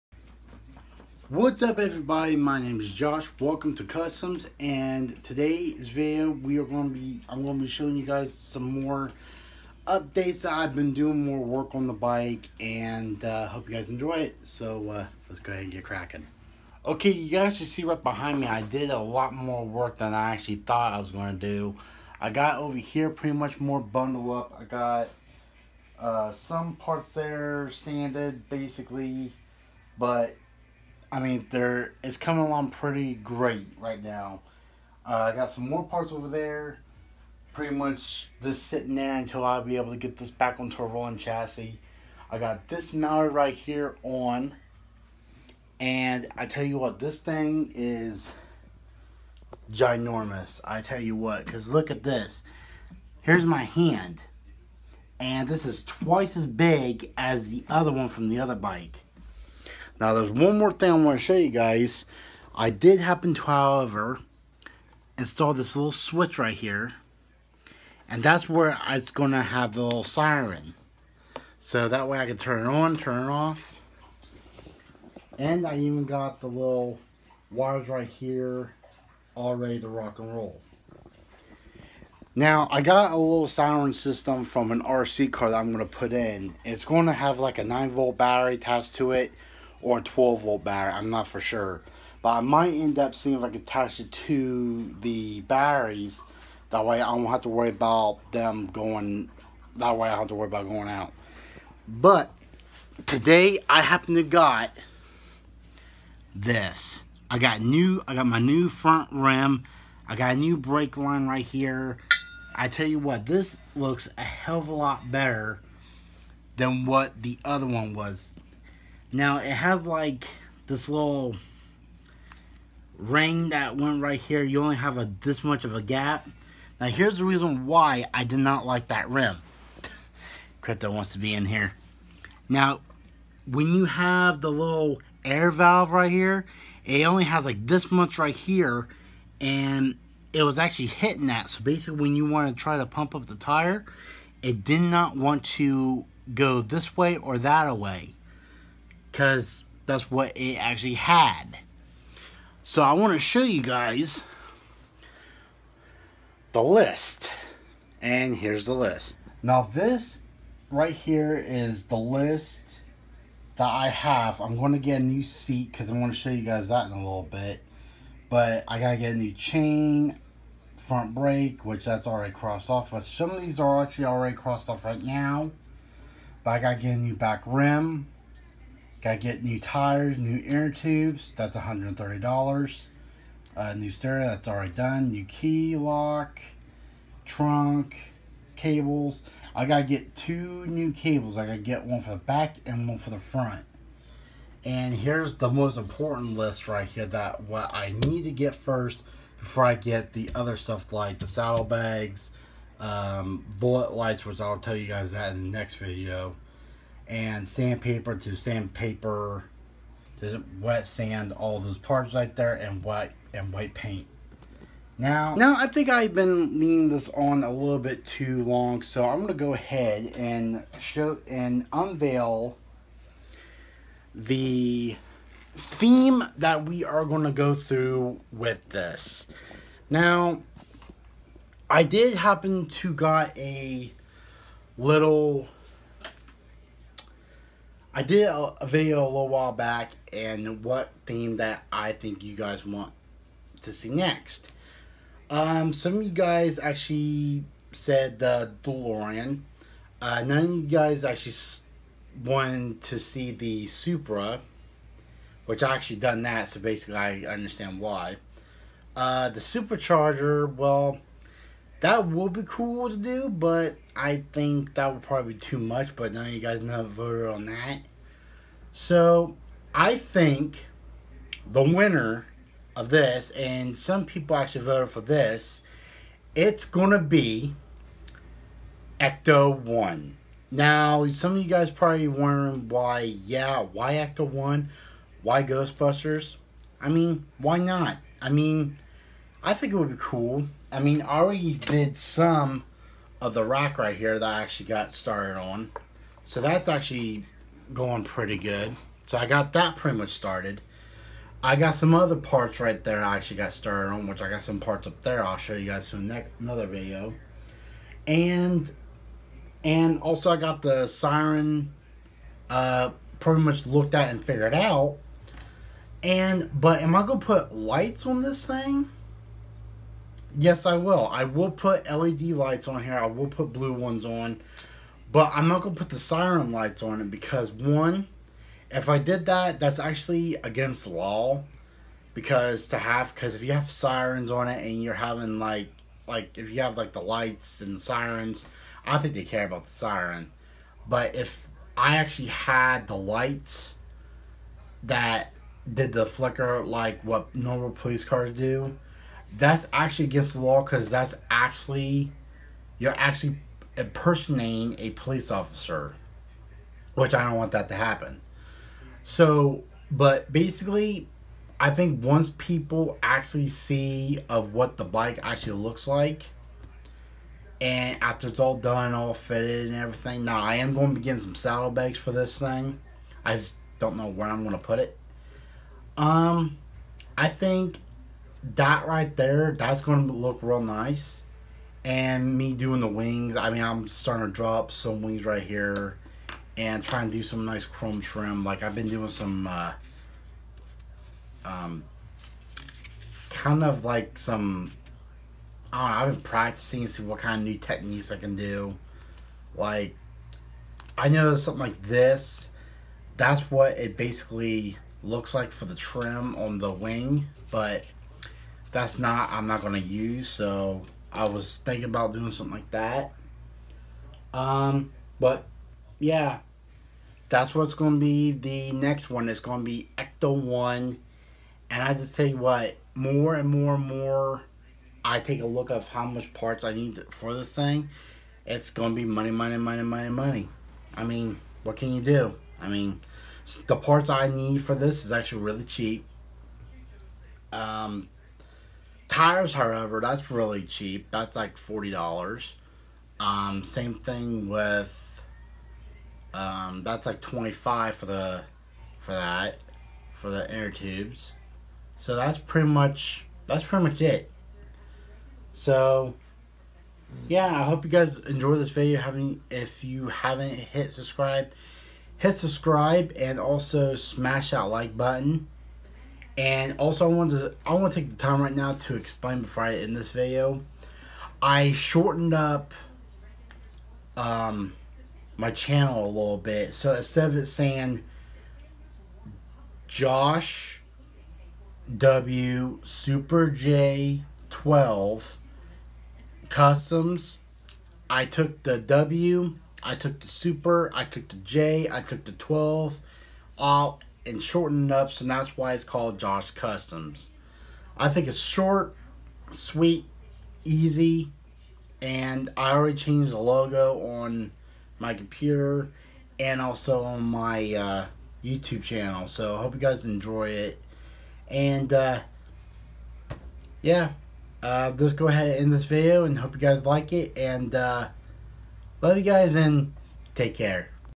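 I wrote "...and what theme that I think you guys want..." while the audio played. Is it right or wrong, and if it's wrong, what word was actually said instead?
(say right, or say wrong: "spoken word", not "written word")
right.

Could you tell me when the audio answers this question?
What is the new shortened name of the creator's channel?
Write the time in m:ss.
8:16.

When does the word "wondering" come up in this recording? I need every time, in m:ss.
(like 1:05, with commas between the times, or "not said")
4:42.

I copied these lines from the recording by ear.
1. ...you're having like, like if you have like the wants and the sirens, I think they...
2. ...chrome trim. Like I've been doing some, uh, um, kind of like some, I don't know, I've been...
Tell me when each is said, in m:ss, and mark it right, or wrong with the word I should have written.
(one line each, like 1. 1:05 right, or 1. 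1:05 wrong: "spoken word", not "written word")
1. 5:34 wrong: "lights", not "wants"
2. 6:27 right.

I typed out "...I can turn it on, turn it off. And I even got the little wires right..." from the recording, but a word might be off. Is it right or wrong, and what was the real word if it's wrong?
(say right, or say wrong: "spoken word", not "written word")
right.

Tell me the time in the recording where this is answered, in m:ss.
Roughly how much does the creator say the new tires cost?
7:21.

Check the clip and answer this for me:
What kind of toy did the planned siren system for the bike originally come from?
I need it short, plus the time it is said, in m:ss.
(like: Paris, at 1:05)
RC car, at 1:24.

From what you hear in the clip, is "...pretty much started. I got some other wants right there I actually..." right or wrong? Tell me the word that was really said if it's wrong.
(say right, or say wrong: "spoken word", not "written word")
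wrong: "parts", not "wants".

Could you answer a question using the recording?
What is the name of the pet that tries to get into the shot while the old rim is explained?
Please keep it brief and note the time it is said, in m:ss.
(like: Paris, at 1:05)
Crypto, at 2:10.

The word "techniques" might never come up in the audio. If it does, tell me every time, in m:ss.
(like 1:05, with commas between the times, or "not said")
6:37.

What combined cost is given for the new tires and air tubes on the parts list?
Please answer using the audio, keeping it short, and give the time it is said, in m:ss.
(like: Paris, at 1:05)
$130, at 3:01.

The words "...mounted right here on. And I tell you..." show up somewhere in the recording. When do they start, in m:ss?
0:42.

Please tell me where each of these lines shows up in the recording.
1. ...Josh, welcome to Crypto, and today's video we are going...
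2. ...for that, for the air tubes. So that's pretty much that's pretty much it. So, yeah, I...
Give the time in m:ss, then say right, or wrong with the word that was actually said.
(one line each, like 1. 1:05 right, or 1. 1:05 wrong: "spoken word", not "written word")
1. 0:02 wrong: "Customs", not "Crypto"
2. 7:28 right.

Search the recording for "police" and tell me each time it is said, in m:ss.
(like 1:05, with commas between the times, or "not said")
5:47, 5:54.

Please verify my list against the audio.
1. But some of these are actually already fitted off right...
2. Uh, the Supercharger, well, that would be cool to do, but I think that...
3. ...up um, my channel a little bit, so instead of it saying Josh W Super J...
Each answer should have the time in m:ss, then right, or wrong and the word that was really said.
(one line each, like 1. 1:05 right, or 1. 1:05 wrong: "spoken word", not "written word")
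1. 2:52 wrong: "crossed", not "fitted"
2. 4:18 right
3. 7:52 right.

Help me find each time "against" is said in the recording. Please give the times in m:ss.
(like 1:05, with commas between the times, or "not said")
5:30, 5:50.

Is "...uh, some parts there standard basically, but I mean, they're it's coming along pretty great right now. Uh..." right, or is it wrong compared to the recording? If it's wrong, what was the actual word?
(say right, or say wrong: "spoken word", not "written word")
right.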